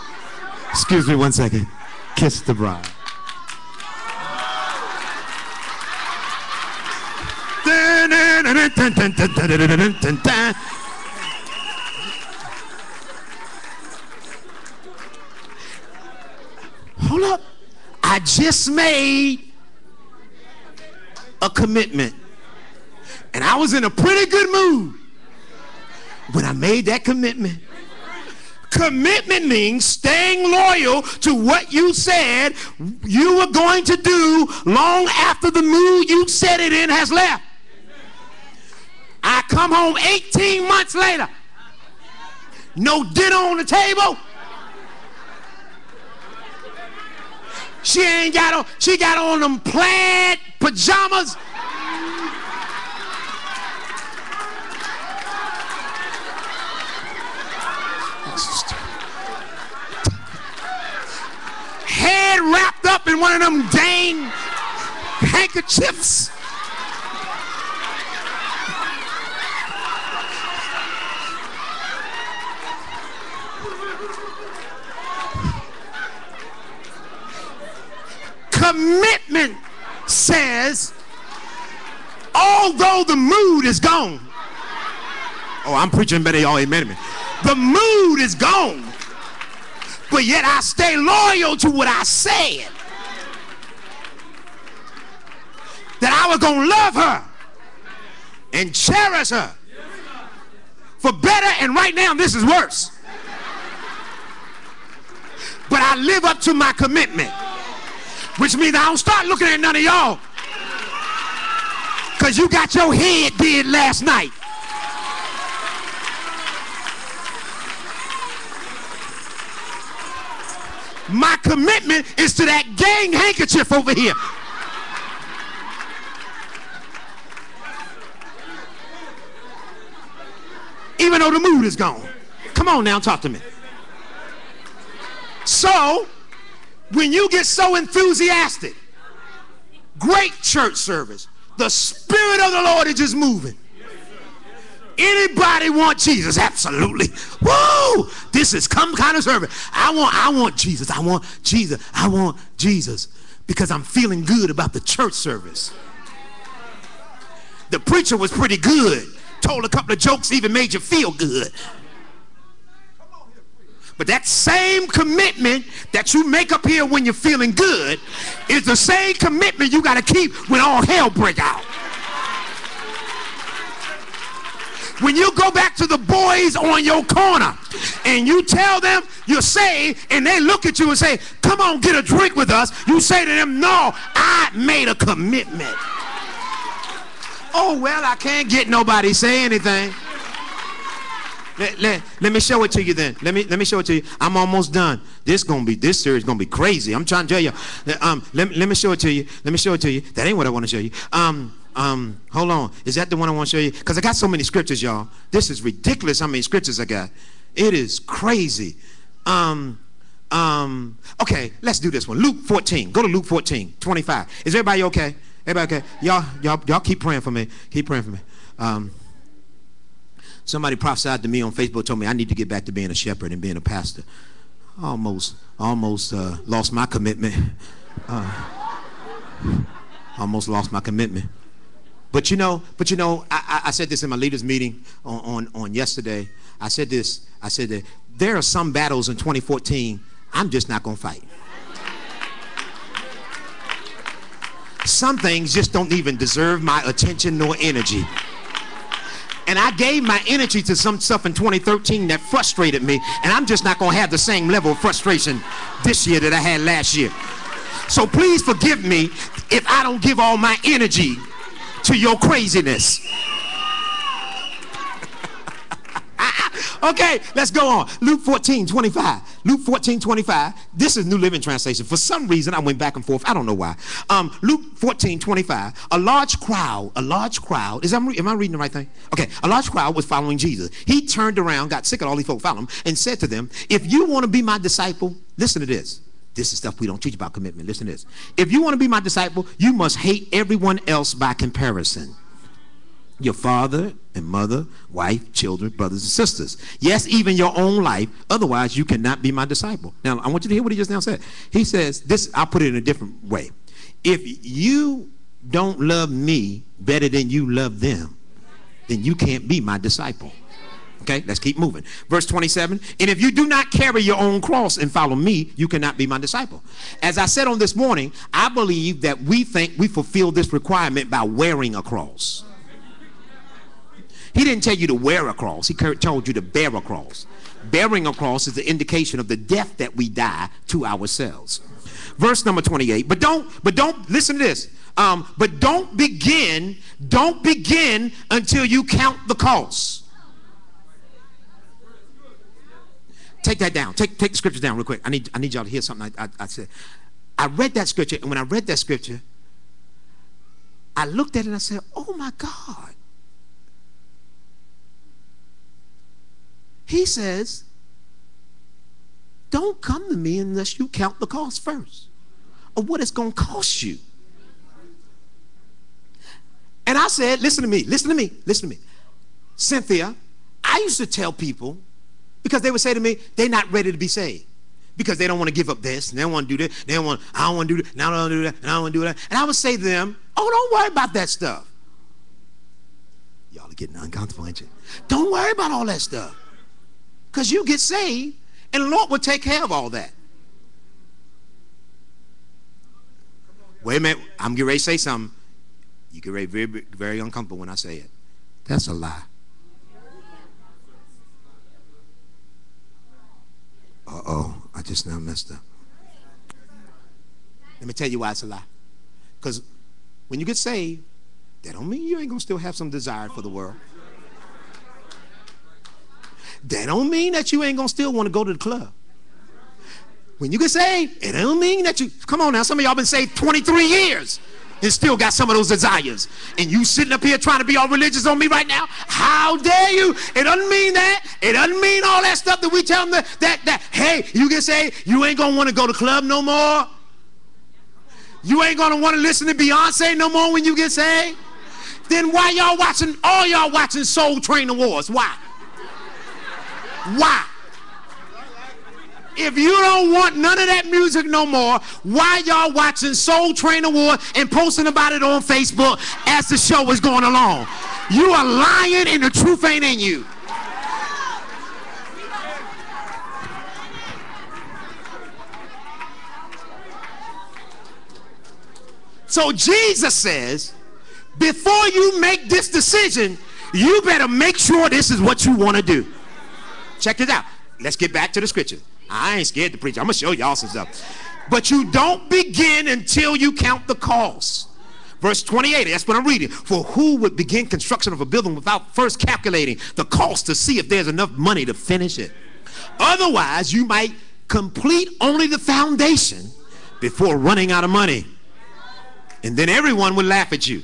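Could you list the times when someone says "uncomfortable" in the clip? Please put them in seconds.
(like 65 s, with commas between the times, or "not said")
383 s, 397 s.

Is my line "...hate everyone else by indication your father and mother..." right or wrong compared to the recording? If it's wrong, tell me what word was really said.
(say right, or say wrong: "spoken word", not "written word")
wrong: "comparison", not "indication".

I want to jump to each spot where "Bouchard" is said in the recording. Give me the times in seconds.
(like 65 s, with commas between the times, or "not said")
not said.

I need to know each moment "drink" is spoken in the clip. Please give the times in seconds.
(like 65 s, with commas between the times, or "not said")
182 s.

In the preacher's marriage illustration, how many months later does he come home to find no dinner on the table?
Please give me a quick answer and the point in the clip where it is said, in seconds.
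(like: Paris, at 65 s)
18, at 39 s.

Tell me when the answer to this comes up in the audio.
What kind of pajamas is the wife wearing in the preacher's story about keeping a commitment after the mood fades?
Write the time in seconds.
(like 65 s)
49 s.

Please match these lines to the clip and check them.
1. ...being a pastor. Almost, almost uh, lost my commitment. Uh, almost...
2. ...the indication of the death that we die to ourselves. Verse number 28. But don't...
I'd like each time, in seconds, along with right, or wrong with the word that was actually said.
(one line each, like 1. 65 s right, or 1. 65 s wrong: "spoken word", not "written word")
1. 223 s right
2. 328 s right.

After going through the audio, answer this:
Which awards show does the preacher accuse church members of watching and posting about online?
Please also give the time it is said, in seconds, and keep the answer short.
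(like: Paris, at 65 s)
Soul Train Awards, at 444 s.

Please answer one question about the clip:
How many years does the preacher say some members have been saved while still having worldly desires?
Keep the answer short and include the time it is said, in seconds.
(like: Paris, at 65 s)
23, at 423 s.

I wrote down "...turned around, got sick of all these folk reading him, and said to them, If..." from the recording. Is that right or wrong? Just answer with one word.
wrong.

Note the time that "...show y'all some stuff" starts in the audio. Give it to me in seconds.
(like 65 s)
480 s.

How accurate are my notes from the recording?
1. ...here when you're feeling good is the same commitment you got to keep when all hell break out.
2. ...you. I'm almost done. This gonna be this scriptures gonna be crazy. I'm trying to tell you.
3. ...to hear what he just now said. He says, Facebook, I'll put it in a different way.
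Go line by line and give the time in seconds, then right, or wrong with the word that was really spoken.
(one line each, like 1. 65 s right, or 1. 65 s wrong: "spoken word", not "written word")
1. 166 s right
2. 193 s wrong: "series", not "scriptures"
3. 300 s wrong: "This", not "Facebook".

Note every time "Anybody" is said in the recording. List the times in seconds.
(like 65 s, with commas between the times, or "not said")
144 s.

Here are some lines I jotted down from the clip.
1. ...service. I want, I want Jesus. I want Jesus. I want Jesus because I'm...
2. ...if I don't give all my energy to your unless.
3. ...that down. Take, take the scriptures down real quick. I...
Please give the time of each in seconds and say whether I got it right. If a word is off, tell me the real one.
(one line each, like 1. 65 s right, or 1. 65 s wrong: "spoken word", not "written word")
1. 149 s right
2. 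259 s wrong: "craziness", not "unless"
3. 343 s right.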